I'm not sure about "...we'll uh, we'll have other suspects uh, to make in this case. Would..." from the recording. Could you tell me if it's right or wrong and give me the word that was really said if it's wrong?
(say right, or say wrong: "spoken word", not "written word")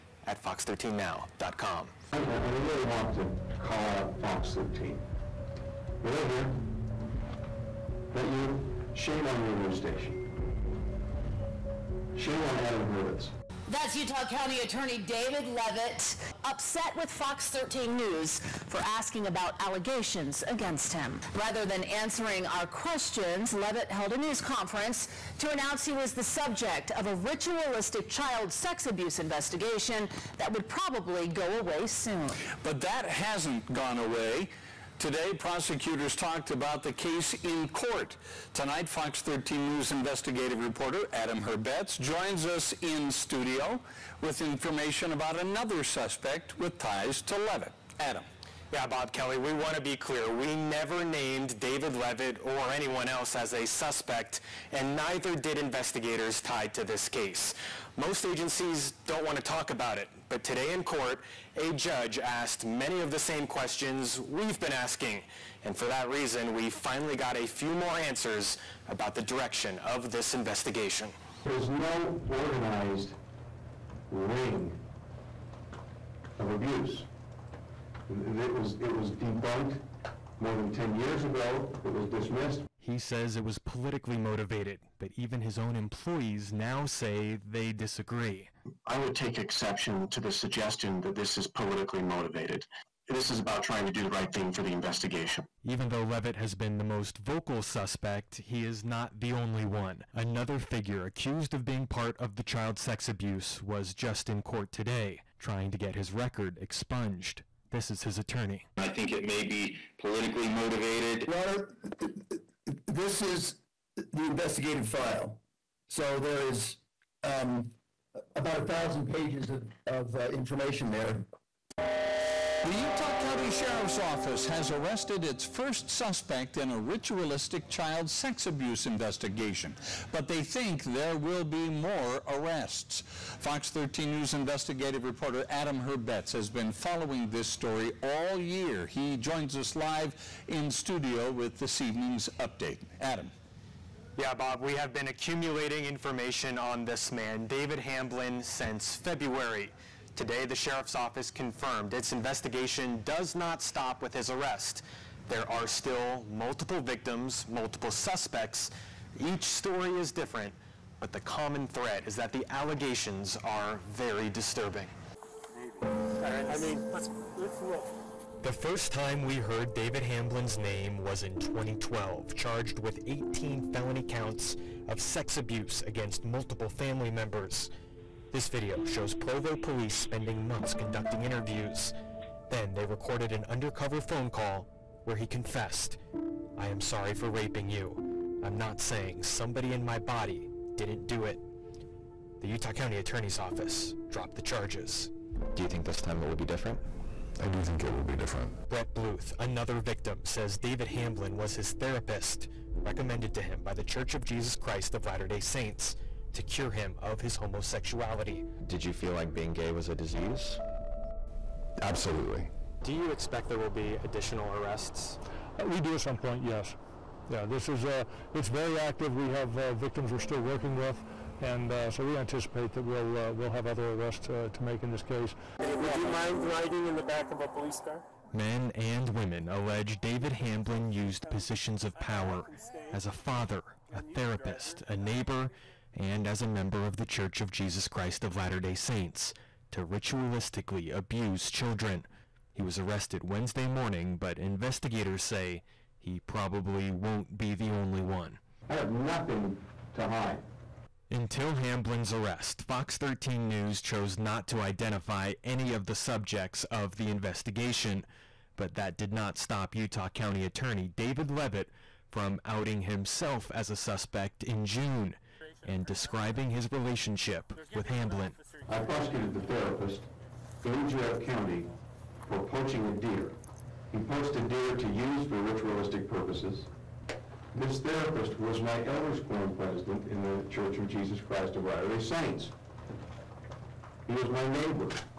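wrong: "arrests", not "suspects".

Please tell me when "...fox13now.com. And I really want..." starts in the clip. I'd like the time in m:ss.
0:00.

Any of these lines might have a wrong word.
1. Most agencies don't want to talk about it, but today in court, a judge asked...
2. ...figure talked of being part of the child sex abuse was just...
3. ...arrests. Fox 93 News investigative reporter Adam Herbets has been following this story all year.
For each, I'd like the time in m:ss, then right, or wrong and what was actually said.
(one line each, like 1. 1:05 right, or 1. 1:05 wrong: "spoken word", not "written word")
1. 0:57 right
2. 1:40 wrong: "accused", not "talked"
3. 2:12 wrong: "13", not "93".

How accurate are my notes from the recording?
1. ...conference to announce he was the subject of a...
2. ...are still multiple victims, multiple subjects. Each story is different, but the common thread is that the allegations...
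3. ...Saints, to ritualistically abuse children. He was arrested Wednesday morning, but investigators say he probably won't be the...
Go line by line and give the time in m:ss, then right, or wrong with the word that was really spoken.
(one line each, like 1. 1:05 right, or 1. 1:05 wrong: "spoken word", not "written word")
1. 0:24 right
2. 2:35 wrong: "suspects", not "subjects"
3. 3:58 right.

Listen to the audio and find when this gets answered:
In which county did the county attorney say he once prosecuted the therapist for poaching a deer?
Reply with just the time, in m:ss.
4:30.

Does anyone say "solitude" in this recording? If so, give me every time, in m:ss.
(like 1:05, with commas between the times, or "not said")
not said.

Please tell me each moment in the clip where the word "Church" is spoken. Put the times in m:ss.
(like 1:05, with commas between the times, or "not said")
3:23, 3:57, 4:40.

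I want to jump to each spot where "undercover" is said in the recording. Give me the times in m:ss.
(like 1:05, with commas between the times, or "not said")
3:03.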